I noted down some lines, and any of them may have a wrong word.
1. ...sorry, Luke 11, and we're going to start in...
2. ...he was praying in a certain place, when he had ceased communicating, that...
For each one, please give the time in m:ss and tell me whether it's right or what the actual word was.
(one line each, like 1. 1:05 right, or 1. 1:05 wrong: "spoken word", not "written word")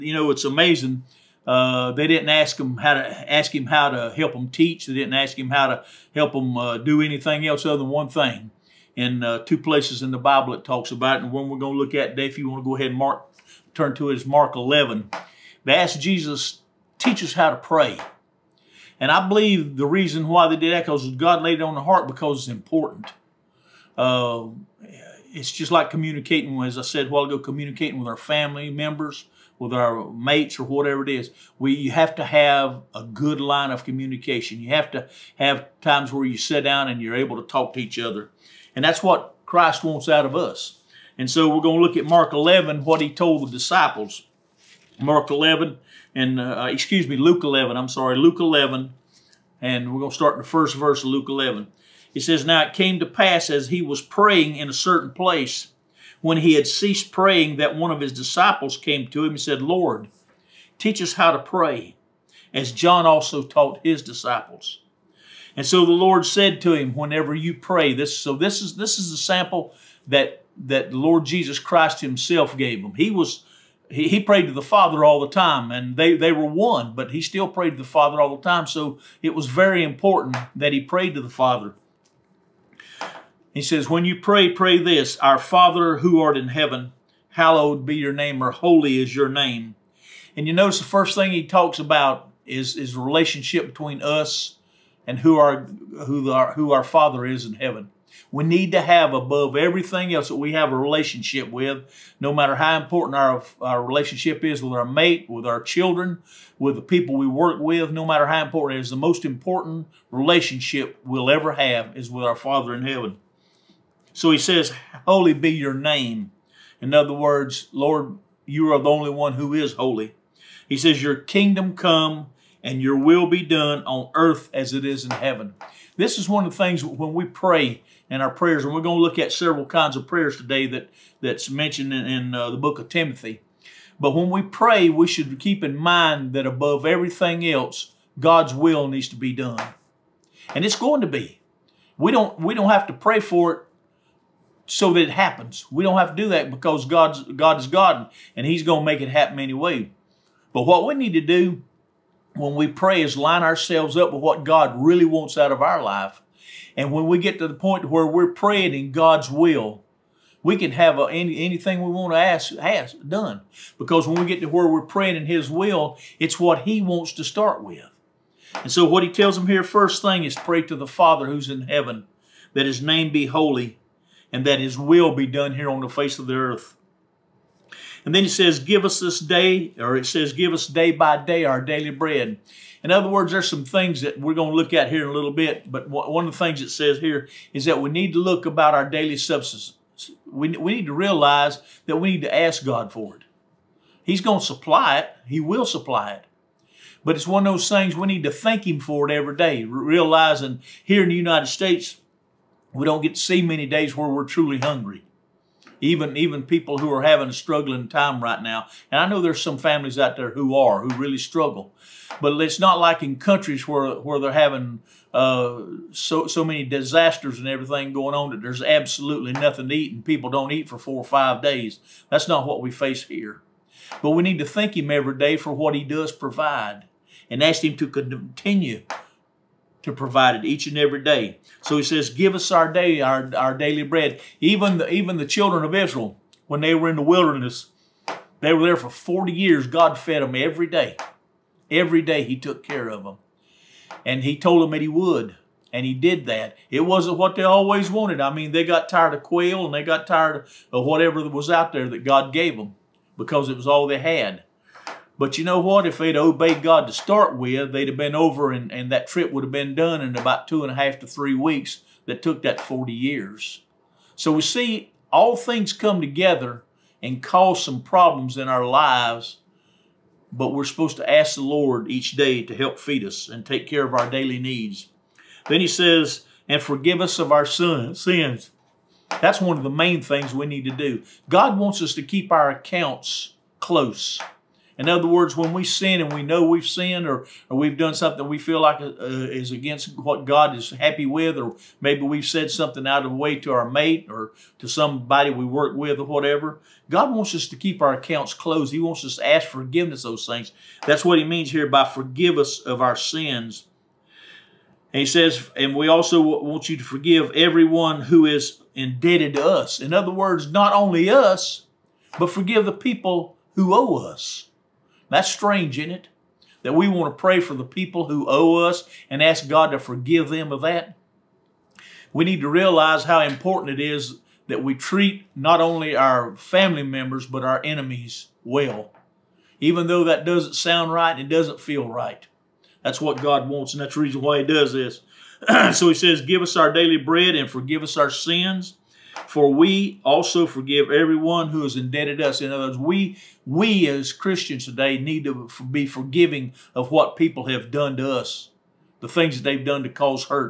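1. 0:47 right
2. 0:53 wrong: "praying", not "communicating".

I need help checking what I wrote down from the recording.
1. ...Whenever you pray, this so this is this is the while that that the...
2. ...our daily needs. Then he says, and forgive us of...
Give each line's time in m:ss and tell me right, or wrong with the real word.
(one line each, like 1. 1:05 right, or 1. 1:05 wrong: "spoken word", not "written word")
1. 1:06 wrong: "sample", not "while"
2. 4:33 right.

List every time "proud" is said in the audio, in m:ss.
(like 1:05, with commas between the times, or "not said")
not said.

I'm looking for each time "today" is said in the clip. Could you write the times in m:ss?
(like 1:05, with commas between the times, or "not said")
0:12, 2:10, 5:44.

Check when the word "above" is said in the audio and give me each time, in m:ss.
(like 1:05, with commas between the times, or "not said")
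1:39, 2:16.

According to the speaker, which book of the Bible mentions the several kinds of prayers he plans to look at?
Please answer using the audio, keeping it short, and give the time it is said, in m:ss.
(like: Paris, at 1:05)
Timothy, at 2:12.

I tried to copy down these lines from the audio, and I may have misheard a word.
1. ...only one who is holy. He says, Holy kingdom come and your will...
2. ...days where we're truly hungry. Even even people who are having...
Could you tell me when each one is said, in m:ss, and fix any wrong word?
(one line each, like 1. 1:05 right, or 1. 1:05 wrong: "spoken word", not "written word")
1. 1:58 wrong: "Your", not "Holy"
2. 3:23 right.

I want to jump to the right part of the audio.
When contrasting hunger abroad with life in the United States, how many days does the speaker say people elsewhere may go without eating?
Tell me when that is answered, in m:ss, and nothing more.
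3:40.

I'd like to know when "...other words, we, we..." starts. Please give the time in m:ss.
5:42.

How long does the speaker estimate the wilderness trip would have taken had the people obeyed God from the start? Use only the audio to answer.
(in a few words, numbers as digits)
two and a half to three weeks.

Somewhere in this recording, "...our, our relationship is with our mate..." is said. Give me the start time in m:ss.
1:43.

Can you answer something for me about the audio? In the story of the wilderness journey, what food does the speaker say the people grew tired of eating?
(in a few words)
quail.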